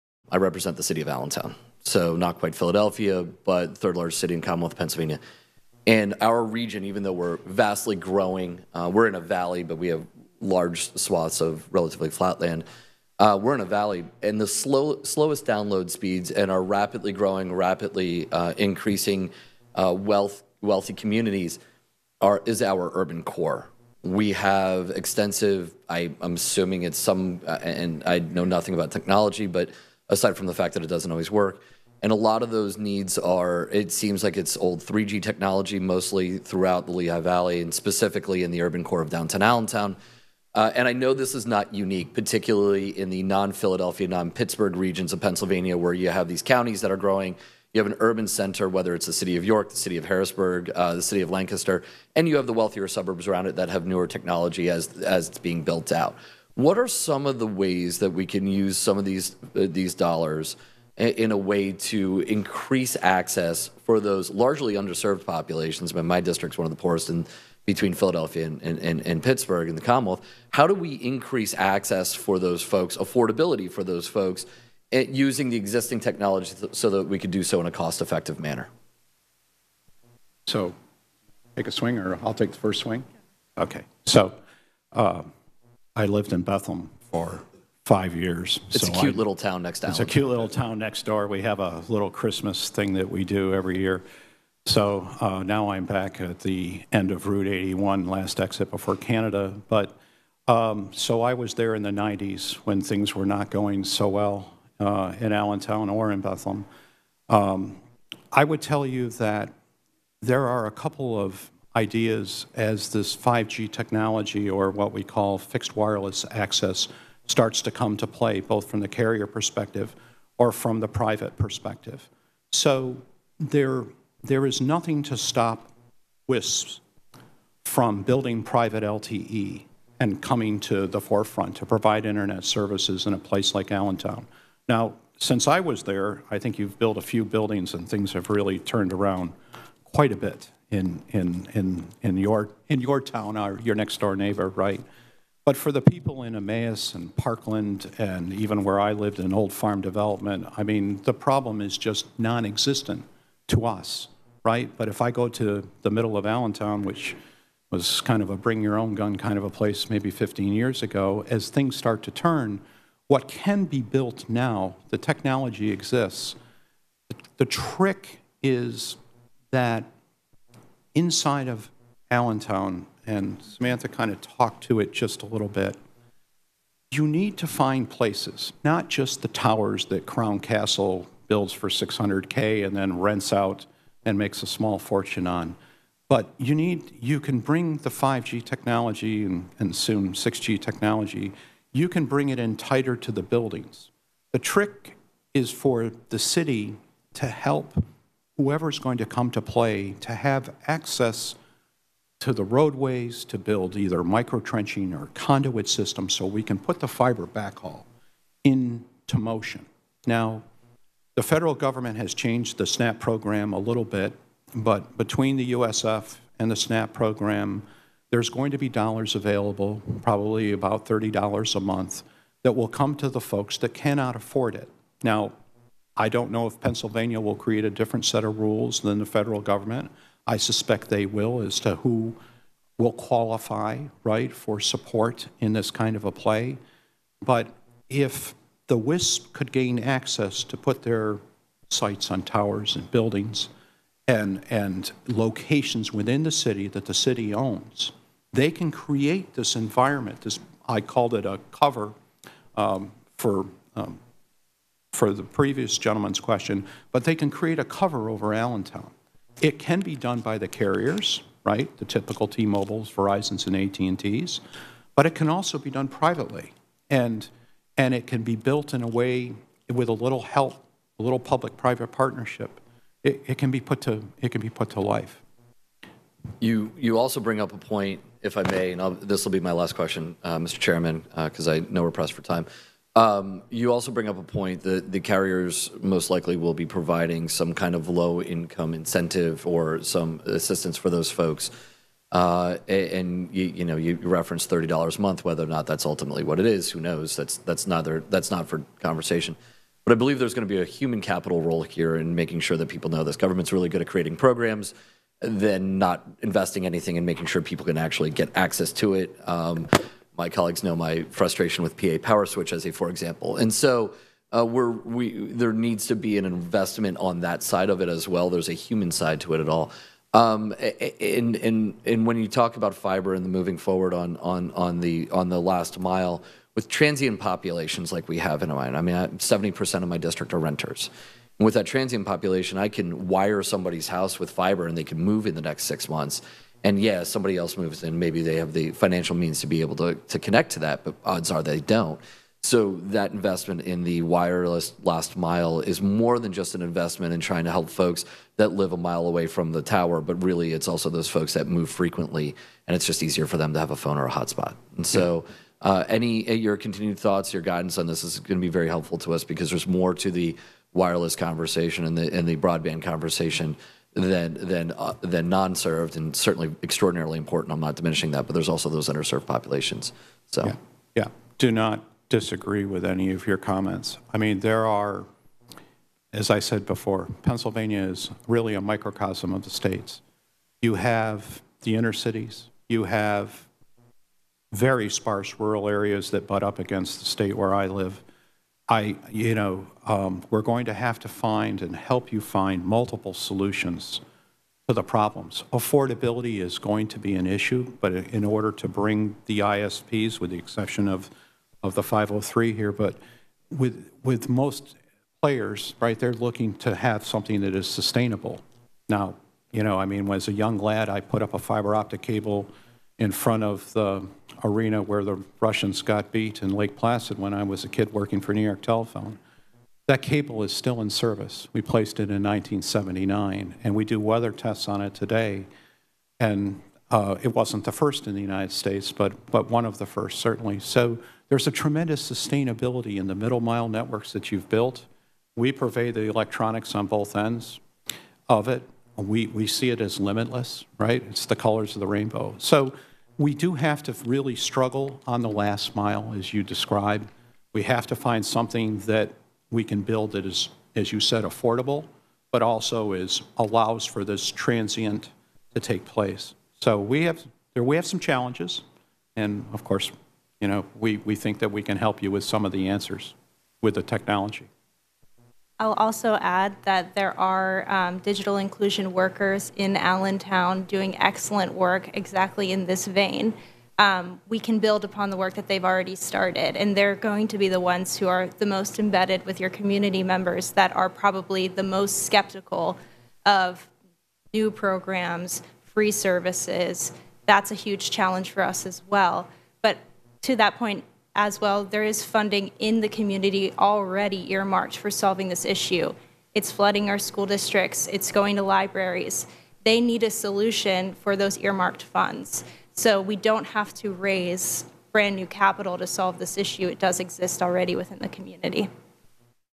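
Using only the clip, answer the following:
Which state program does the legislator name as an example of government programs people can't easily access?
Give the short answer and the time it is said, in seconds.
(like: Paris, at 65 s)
PA Power Switch, at 311 s.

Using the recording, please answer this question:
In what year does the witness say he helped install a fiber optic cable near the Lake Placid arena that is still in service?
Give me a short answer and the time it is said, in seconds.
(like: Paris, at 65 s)
1979, at 422 s.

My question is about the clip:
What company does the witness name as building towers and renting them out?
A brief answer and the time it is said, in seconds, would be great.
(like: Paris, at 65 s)
Crown Castle, at 180 s.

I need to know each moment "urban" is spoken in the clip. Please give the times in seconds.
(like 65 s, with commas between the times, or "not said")
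22 s, 38 s, 48 s.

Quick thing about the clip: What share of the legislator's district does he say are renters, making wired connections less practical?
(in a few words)
70%.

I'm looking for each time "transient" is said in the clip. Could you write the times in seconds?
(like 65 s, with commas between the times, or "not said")
326 s, 331 s, 454 s.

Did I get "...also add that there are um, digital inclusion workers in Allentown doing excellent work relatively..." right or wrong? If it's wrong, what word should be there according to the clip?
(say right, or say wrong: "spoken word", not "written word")
wrong: "exactly", not "relatively".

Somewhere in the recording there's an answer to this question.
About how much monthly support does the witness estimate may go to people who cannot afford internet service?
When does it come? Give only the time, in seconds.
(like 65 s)
220 s.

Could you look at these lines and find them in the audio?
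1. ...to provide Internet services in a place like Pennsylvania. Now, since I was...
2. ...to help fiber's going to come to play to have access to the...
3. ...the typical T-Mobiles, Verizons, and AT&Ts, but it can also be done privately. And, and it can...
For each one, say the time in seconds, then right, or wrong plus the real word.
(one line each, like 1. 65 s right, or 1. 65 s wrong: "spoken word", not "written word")
1. 131 s wrong: "Allentown", not "Pennsylvania"
2. 197 s wrong: "whoever", not "fiber"
3. 261 s right.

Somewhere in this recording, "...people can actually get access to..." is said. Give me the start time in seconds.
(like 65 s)
307 s.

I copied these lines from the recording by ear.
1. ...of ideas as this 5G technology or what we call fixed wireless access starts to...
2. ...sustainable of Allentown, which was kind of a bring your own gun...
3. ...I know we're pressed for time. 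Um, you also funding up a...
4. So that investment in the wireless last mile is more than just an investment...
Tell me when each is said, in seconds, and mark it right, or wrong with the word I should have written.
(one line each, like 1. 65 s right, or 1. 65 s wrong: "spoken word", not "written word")
1. 111 s right
2. 155 s wrong: "middle", not "sustainable"
3. 281 s wrong: "bring", not "funding"
4. 342 s right.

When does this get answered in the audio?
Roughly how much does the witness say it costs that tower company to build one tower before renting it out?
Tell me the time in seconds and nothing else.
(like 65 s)
181 s.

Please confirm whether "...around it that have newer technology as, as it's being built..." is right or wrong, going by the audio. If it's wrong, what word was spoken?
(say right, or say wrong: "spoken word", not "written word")
right.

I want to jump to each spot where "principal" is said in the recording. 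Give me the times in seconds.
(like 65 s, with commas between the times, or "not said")
not said.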